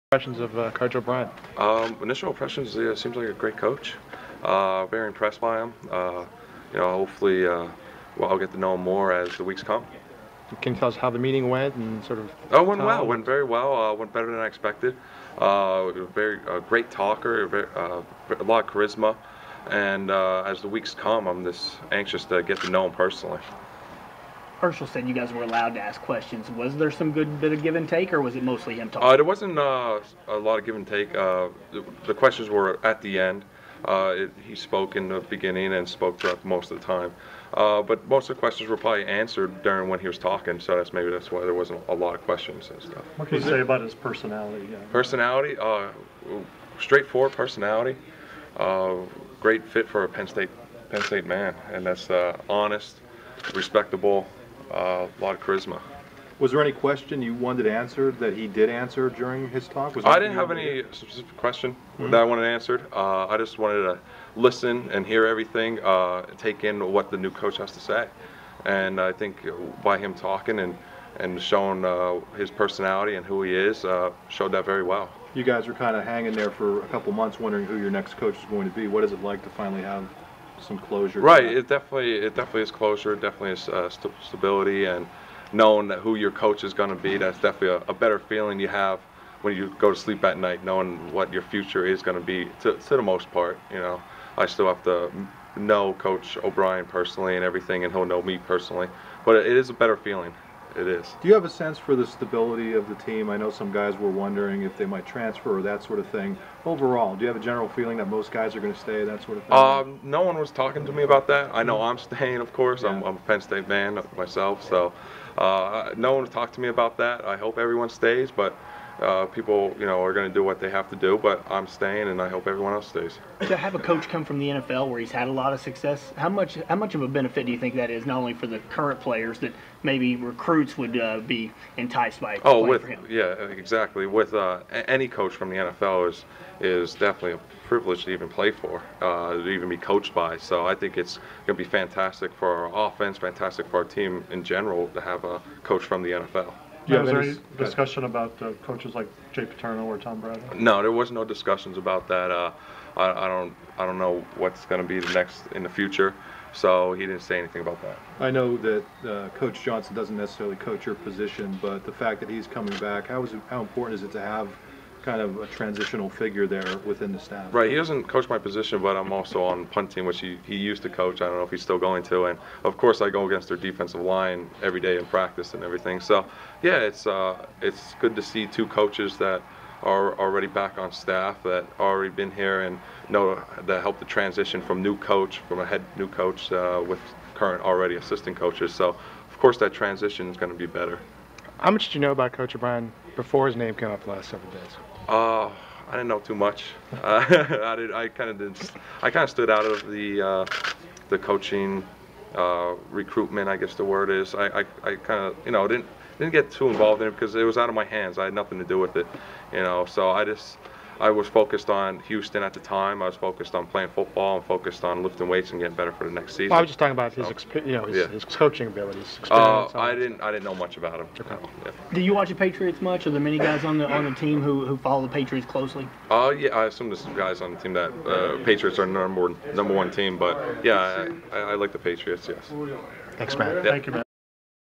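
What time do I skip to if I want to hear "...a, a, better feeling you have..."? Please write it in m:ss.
1:27.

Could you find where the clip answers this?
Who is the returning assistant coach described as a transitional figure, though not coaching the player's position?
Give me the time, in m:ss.
2:39.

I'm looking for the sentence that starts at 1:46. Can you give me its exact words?
Overall, do you have a general feeling that most guys are going to stay, that sort of thing?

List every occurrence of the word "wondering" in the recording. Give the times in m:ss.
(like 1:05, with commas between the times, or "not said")
1:17, 1:44.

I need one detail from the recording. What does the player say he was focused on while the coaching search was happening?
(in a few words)
Houston.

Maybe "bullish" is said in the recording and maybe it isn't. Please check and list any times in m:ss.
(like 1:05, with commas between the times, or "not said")
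not said.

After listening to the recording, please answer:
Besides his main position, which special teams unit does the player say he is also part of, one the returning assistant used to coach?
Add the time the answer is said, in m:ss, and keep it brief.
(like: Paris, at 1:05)
Punting, at 2:49.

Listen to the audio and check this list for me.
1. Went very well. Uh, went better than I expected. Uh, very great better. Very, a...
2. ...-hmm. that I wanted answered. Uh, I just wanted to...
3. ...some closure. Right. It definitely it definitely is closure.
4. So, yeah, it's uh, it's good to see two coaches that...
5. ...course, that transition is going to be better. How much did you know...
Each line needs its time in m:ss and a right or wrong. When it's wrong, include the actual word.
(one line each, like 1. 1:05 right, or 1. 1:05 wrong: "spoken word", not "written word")
1. 0:13 wrong: "talker", not "better"
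2. 1:02 right
3. 1:20 right
4. 2:55 right
5. 3:09 right.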